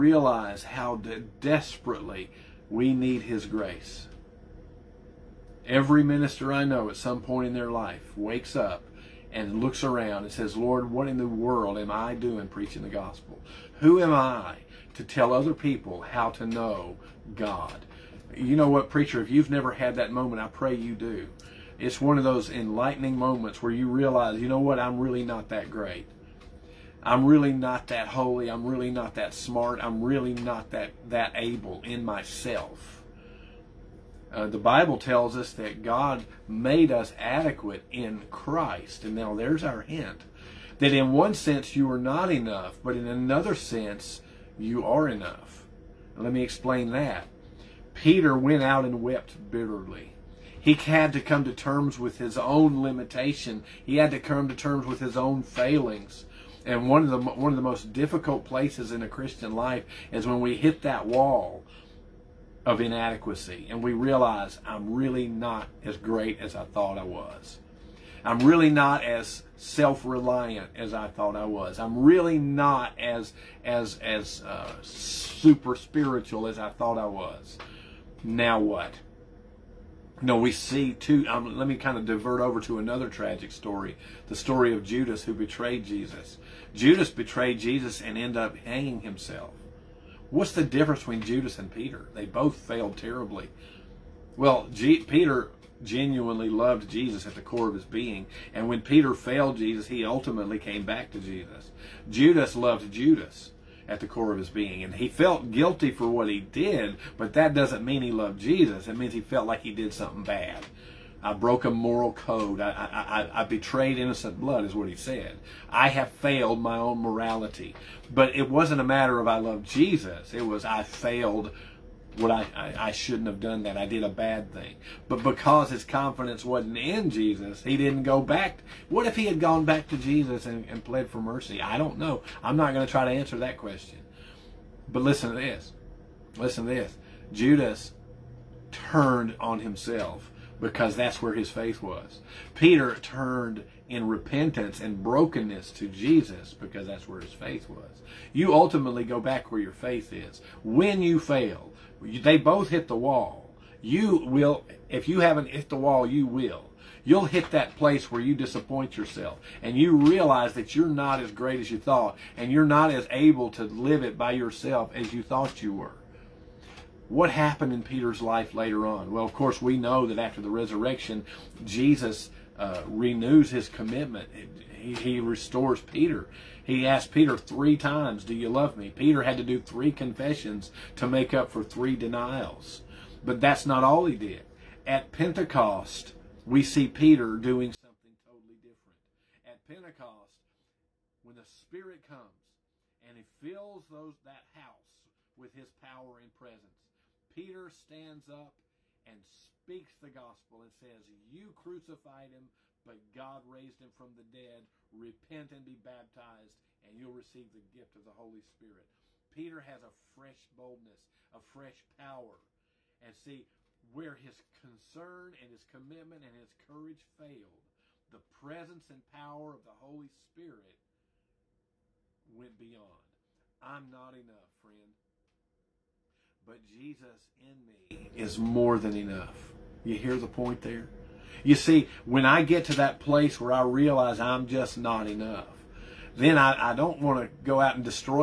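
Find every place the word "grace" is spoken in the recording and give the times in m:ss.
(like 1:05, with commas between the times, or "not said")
0:03.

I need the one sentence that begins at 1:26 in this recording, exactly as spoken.
Judas betrayed Jesus and ended up hanging himself.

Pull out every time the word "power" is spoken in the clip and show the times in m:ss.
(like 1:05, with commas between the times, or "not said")
3:15, 3:31, 3:39.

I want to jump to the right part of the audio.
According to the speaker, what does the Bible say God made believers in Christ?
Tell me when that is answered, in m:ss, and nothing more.
0:37.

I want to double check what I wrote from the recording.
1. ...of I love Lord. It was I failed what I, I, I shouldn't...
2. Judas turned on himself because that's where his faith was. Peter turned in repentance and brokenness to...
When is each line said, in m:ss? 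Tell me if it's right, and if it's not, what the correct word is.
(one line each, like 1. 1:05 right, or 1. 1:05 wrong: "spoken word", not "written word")
1. 1:59 wrong: "Jesus", not "Lord"
2. 2:17 right.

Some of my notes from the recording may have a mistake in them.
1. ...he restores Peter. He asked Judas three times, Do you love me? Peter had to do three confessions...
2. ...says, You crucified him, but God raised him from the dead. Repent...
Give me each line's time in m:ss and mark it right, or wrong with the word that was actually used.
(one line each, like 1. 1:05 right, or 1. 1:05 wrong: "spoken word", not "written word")
1. 2:54 wrong: "Peter", not "Judas"
2. 3:20 right.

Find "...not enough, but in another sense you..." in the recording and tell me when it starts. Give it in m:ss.
0:41.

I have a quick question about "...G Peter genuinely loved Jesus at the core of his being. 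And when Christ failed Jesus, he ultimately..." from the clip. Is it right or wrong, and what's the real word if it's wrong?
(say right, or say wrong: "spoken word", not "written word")
wrong: "Peter", not "Christ".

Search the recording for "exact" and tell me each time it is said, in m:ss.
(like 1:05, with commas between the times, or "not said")
not said.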